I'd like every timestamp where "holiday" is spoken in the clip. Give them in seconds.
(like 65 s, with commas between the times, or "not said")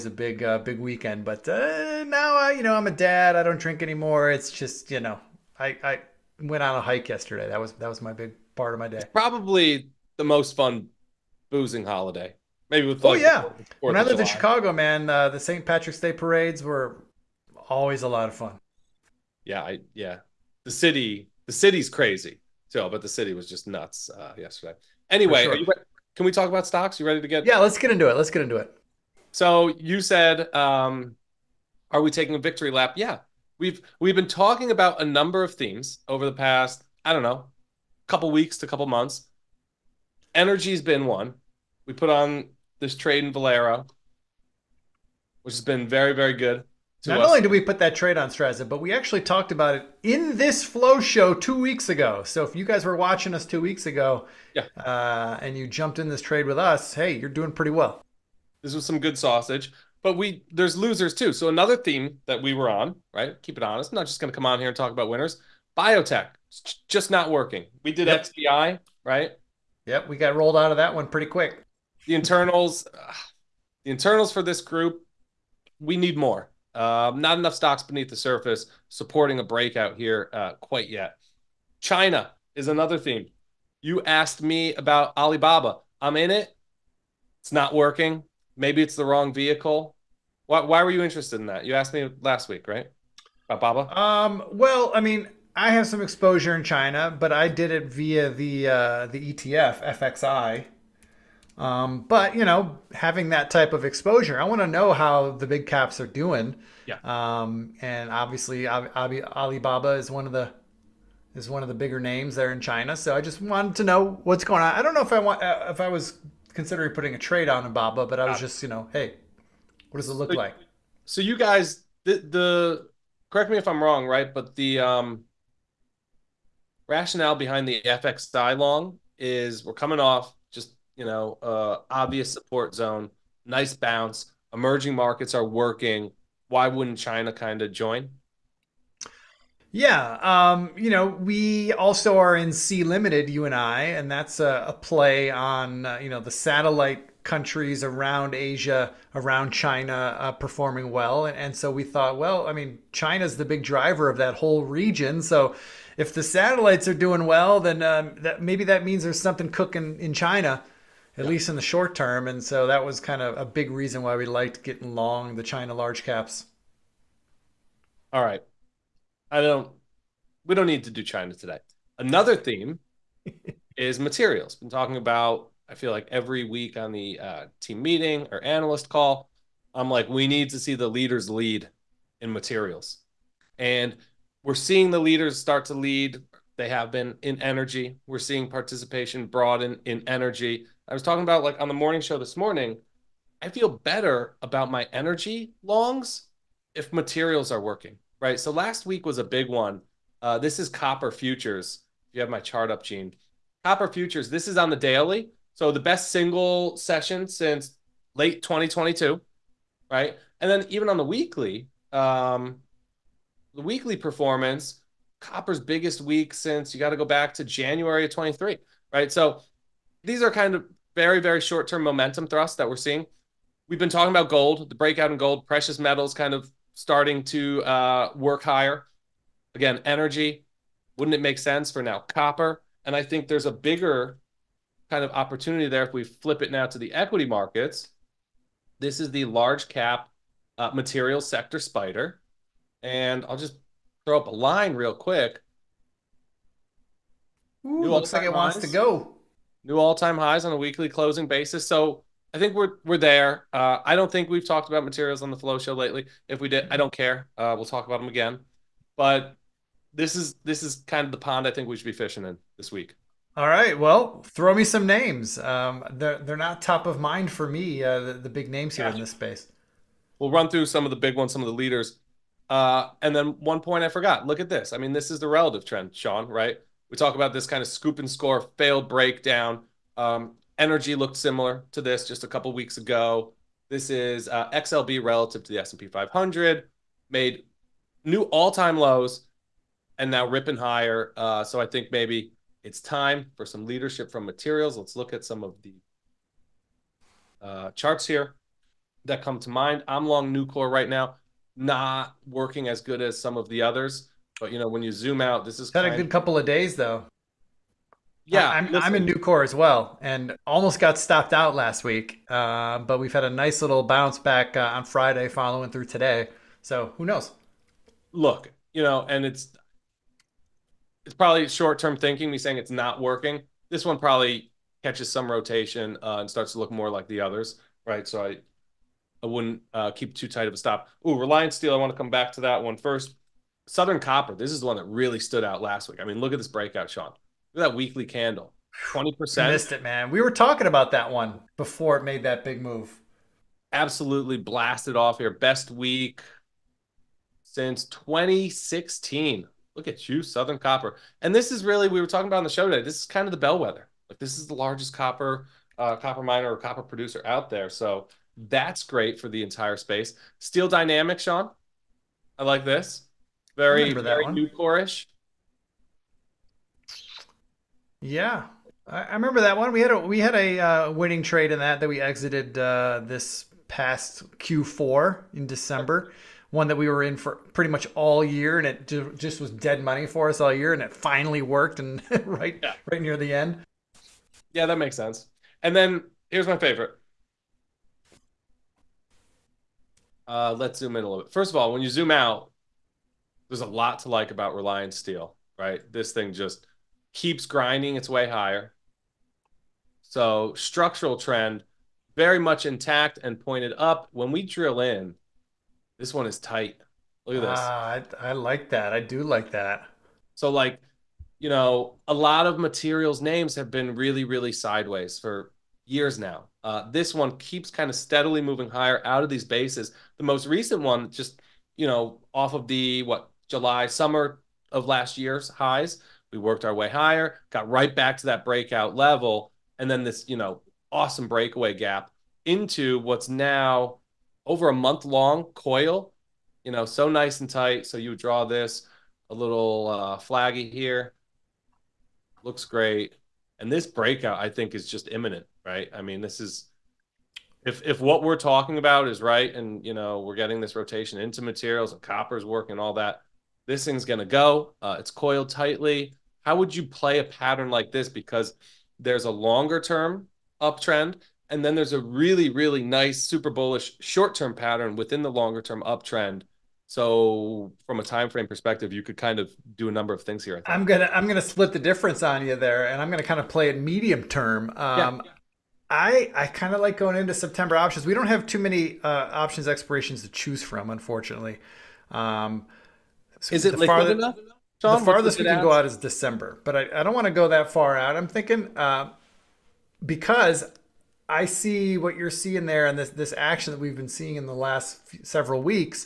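11 s.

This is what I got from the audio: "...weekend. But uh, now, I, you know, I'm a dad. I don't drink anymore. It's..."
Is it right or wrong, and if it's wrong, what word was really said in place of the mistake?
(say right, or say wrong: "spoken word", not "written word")
right.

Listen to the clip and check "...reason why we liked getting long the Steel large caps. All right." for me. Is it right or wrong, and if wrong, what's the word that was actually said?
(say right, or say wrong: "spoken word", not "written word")
wrong: "China", not "Steel".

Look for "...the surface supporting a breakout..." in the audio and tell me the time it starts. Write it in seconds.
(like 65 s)
78 s.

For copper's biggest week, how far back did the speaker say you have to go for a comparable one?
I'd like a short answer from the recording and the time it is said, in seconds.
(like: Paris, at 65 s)
January 2023, at 217 s.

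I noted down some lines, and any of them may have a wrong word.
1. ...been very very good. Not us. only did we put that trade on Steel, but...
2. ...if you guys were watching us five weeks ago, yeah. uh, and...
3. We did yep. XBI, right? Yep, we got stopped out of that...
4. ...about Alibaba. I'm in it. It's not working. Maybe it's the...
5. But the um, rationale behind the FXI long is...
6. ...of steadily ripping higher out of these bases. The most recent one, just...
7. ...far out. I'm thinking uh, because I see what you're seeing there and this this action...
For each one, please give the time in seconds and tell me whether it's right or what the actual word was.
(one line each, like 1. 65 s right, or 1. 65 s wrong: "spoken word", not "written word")
1. 45 s wrong: "Strazza", not "Steel"
2. 52 s wrong: "two", not "five"
3. 67 s wrong: "rolled", not "stopped"
4. 84 s right
5. 124 s right
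6. 417 s wrong: "moving", not "ripping"
7. 487 s right.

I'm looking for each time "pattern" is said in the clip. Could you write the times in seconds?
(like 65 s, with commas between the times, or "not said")
457 s, 464 s.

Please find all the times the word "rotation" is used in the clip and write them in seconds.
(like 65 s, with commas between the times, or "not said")
325 s, 450 s.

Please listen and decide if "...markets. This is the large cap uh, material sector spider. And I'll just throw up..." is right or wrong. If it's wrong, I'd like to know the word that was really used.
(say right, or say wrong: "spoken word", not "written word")
right.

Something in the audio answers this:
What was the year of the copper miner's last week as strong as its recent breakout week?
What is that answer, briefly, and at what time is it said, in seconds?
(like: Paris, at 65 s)
2016, at 347 s.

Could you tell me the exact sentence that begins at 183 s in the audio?
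And we're seeing the leaders start to lead they have been in energy.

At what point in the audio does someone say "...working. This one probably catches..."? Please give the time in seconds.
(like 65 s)
323 s.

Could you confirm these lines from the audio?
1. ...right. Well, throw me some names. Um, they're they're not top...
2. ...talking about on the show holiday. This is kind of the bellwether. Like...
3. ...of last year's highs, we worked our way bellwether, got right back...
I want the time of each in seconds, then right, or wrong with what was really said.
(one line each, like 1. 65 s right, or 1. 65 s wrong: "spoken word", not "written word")
1. 263 s right
2. 352 s wrong: "today", not "holiday"
3. 424 s wrong: "higher", not "bellwether".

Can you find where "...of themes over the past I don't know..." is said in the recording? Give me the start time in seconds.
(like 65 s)
35 s.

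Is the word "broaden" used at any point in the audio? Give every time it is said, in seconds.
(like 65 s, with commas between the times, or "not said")
189 s.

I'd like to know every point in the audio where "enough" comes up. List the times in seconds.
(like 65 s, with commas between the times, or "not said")
77 s, 484 s.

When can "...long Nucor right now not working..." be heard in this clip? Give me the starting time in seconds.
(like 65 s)
300 s.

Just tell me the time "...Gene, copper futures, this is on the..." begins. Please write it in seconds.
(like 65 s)
202 s.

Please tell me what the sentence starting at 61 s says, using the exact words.
So another theme that we were on, right?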